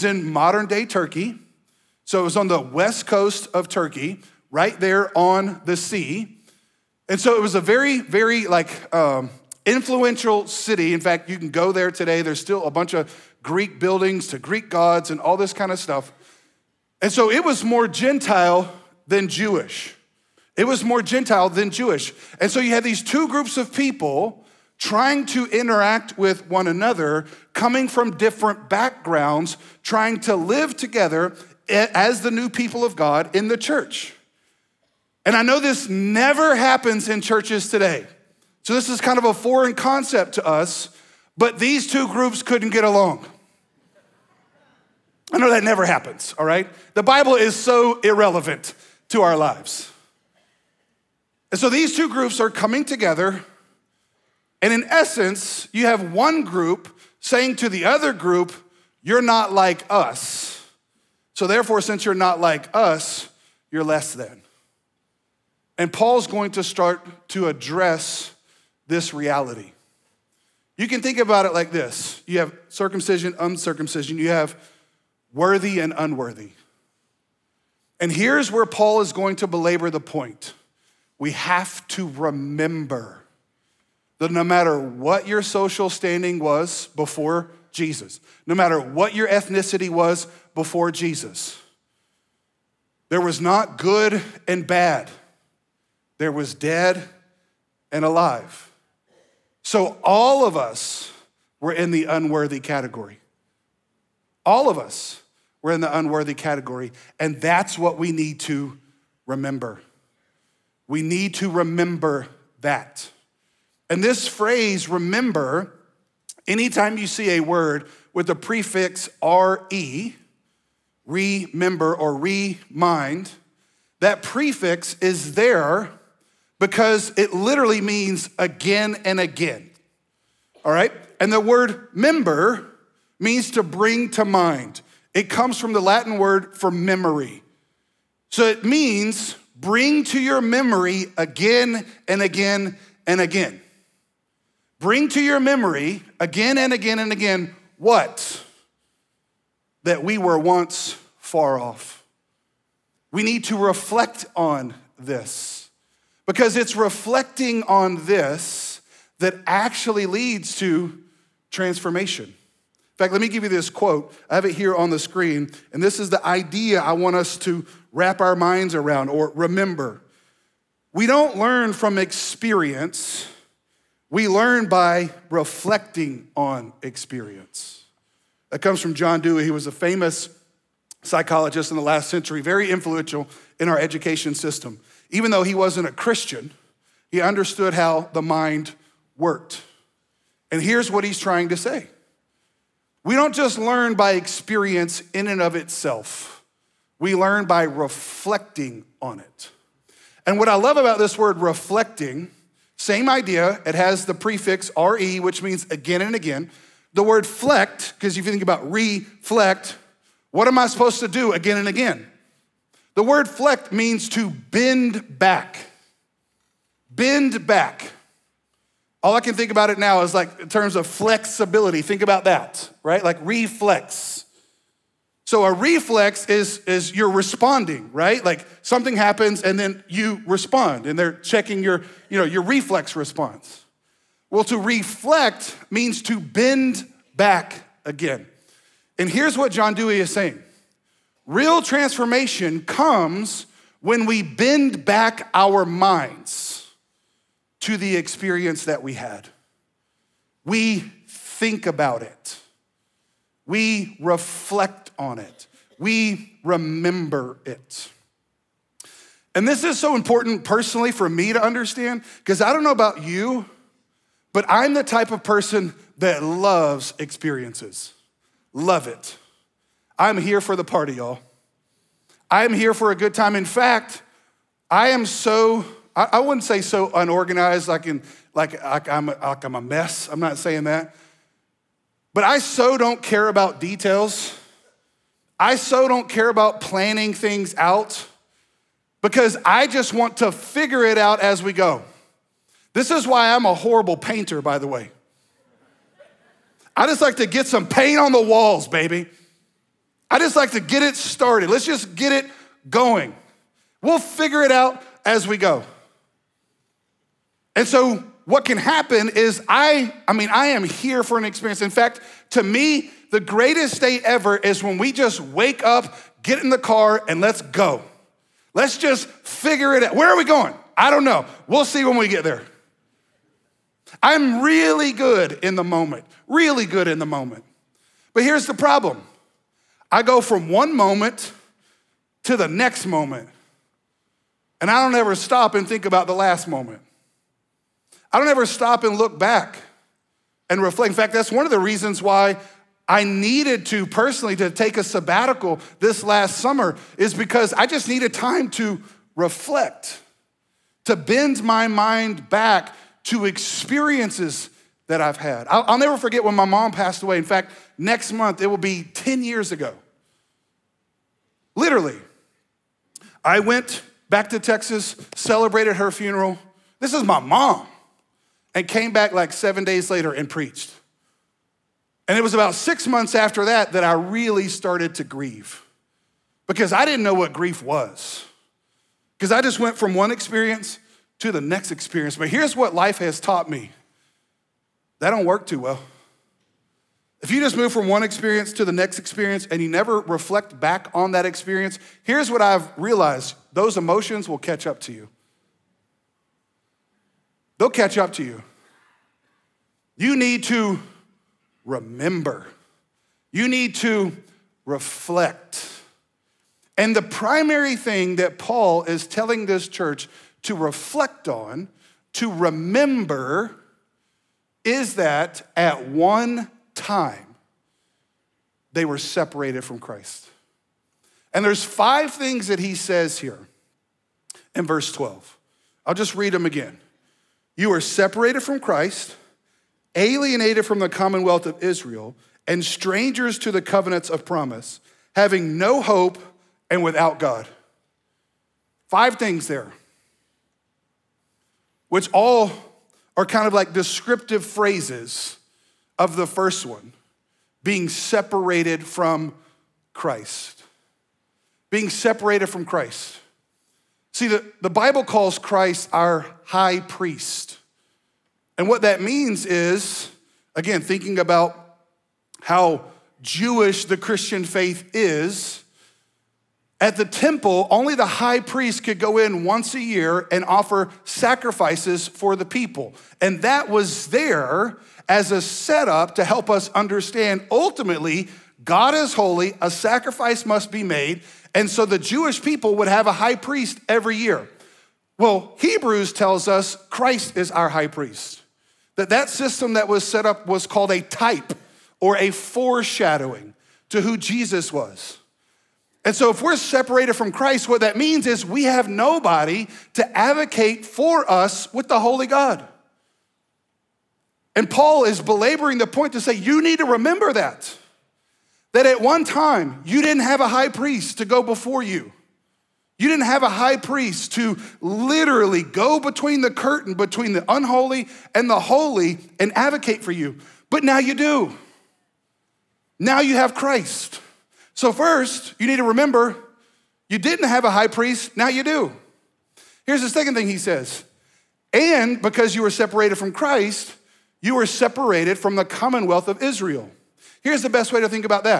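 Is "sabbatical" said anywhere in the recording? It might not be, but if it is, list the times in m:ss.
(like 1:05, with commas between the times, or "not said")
5:44.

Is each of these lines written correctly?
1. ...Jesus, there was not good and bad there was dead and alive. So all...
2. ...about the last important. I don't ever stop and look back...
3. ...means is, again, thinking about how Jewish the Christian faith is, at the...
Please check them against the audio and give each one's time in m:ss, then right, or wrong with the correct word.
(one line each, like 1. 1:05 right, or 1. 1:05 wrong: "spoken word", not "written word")
1. 1:30 right
2. 5:35 wrong: "moment", not "important"
3. 7:39 right.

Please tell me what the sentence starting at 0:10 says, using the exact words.
In fact, you can go there today.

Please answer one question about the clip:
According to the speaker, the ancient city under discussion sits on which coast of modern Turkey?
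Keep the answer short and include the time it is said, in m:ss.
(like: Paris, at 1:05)
West coast, at 0:02.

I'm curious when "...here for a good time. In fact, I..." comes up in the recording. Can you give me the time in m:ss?
4:32.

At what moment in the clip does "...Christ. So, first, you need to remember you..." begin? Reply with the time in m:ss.
8:43.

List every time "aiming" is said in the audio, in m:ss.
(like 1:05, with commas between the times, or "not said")
not said.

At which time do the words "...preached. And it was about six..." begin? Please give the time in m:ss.
6:10.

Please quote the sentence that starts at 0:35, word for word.
And I know this never happens in churches today.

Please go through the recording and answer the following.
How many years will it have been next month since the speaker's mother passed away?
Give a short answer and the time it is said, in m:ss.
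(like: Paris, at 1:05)
10, at 5:58.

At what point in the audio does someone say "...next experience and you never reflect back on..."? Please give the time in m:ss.
6:28.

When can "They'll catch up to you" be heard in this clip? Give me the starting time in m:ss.
6:37.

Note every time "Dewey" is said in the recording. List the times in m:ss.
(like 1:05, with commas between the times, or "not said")
2:59, 3:59.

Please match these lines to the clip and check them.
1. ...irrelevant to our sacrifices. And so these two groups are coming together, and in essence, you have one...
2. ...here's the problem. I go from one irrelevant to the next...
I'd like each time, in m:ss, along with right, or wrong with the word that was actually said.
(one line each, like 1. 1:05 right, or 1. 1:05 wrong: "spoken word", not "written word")
1. 0:48 wrong: "lives", not "sacrifices"
2. 5:28 wrong: "moment", not "irrelevant".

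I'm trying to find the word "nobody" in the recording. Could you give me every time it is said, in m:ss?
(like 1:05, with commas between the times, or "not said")
8:18.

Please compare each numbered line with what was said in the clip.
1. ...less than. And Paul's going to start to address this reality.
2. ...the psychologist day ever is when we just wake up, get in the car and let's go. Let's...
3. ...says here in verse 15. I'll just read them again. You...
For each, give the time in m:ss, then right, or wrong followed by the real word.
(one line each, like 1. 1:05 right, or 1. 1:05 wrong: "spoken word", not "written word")
1. 1:03 right
2. 5:13 wrong: "greatest", not "psychologist"
3. 7:02 wrong: "12", not "15".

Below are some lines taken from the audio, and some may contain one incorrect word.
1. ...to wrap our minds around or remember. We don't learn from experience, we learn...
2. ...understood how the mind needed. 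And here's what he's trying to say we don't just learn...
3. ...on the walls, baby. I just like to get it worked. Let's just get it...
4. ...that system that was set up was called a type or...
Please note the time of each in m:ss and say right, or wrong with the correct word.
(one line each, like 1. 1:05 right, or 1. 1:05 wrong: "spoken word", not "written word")
1. 2:47 right
2. 3:07 wrong: "worked", not "needed"
3. 4:57 wrong: "started", not "worked"
4. 8:09 right.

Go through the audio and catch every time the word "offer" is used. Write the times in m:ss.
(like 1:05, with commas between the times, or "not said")
7:50.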